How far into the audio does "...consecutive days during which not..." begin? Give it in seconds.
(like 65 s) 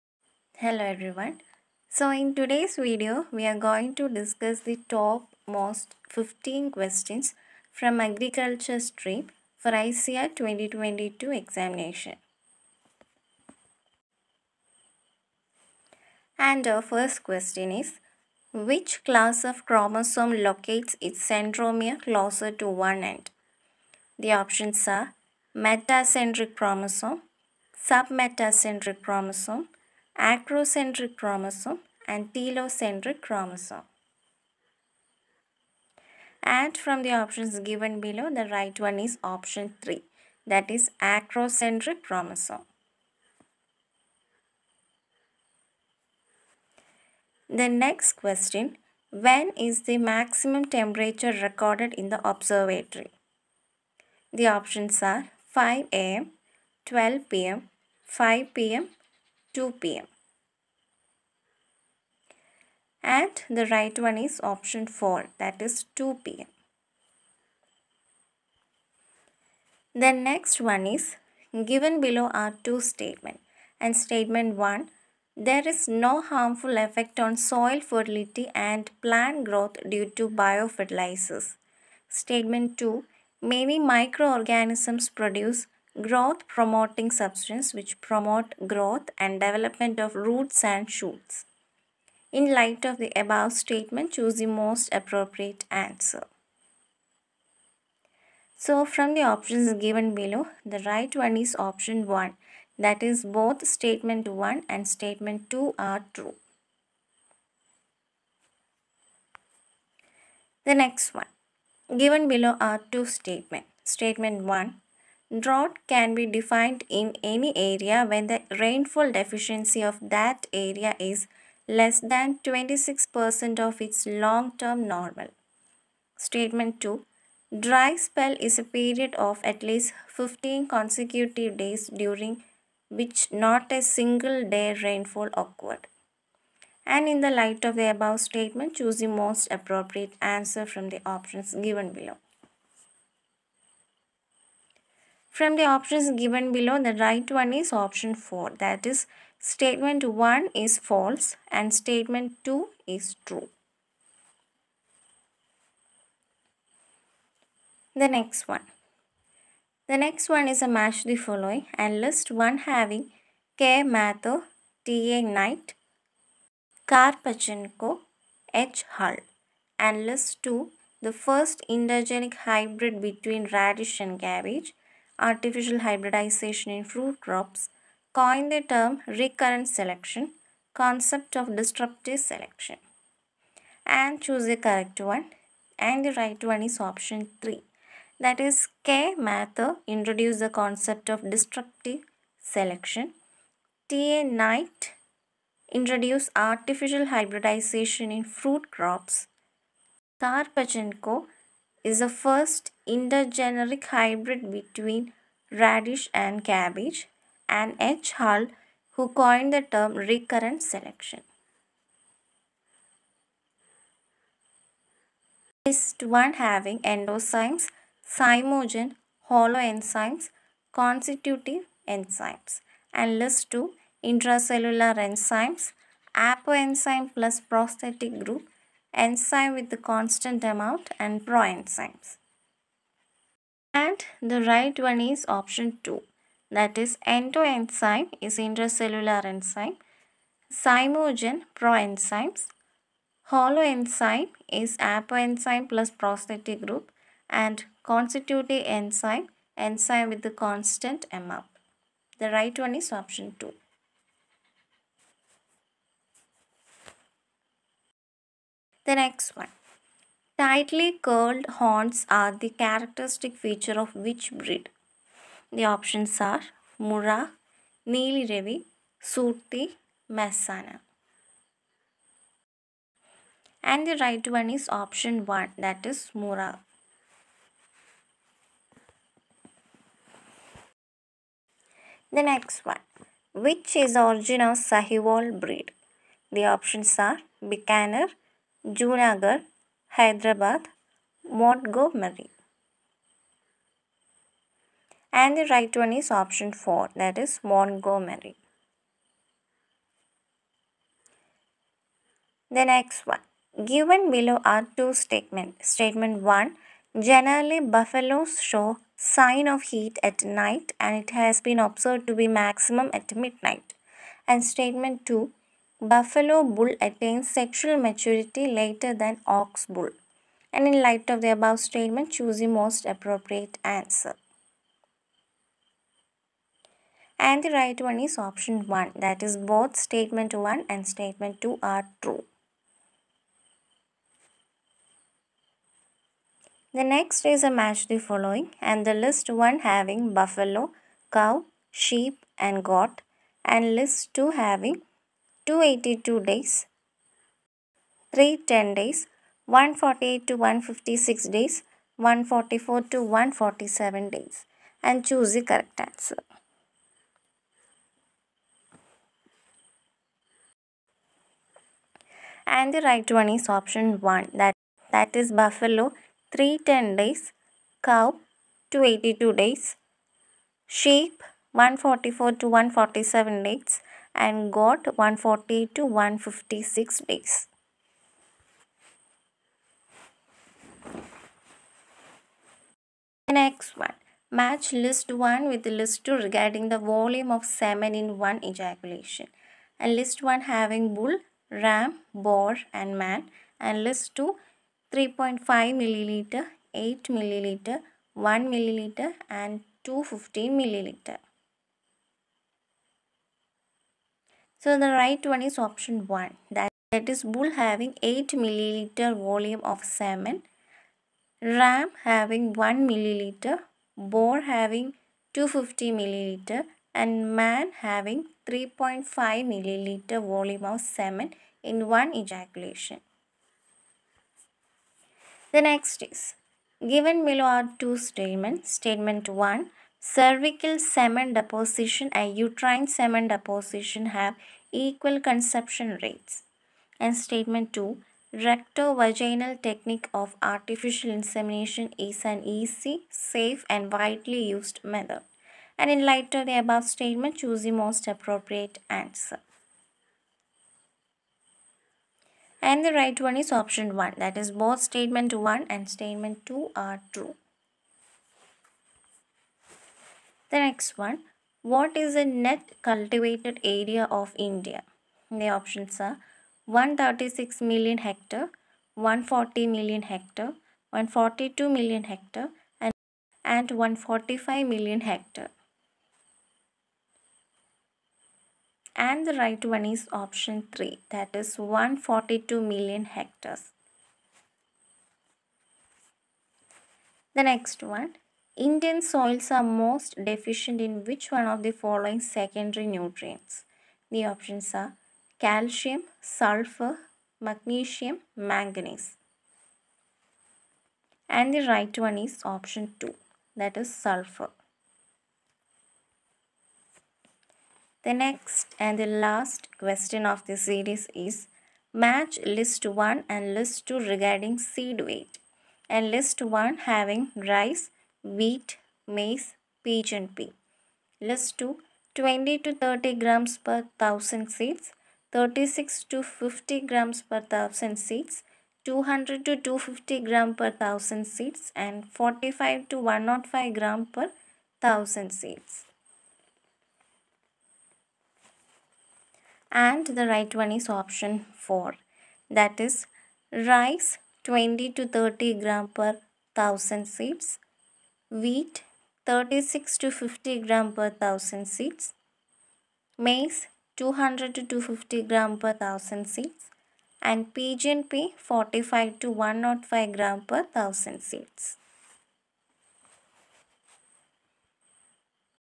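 130 s.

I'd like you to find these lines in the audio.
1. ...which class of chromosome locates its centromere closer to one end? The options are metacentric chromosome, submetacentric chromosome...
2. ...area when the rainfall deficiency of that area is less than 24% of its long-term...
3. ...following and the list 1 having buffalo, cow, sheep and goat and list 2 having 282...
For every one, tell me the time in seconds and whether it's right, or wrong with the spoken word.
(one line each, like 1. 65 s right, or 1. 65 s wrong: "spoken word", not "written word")
1. 18 s right
2. 117 s wrong: "26", not "24"
3. 337 s right.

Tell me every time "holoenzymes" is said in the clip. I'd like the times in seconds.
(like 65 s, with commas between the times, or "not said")
219 s, 243 s.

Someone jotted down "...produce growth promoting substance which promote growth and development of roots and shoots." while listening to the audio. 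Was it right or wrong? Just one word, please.
right.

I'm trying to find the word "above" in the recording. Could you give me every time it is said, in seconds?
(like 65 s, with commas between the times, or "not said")
93 s, 137 s, 321 s, 446 s.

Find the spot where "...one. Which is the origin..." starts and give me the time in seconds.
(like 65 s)
282 s.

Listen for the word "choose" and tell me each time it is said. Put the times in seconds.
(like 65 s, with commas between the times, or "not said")
94 s, 138 s, 184 s, 322 s, 355 s, 447 s.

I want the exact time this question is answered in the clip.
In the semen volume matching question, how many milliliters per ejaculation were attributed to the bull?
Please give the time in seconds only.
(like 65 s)
407 s.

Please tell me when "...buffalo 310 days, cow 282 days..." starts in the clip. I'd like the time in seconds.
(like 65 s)
365 s.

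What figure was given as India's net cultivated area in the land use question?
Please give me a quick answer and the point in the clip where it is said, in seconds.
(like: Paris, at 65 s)
142 million hectares, at 481 s.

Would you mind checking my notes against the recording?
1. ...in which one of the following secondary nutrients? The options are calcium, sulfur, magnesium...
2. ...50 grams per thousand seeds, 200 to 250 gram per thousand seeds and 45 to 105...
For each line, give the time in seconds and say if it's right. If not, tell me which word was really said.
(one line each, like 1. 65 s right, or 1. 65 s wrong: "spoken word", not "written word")
1. 490 s right
2. 526 s right.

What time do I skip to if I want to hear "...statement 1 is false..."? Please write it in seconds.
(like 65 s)
149 s.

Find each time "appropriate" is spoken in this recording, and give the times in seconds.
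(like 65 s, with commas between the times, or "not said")
94 s, 139 s, 322 s, 448 s.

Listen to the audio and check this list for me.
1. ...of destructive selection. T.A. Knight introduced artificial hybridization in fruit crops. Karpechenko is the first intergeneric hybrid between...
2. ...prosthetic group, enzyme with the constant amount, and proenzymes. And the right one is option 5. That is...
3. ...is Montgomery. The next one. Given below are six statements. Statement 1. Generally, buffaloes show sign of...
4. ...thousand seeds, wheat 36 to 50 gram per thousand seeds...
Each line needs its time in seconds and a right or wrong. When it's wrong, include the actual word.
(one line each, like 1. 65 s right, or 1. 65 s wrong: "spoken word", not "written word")
1. 191 s right
2. 227 s wrong: "2", not "5"
3. 297 s wrong: "two", not "six"
4. 546 s right.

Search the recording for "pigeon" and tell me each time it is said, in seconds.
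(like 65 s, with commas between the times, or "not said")
519 s, 557 s.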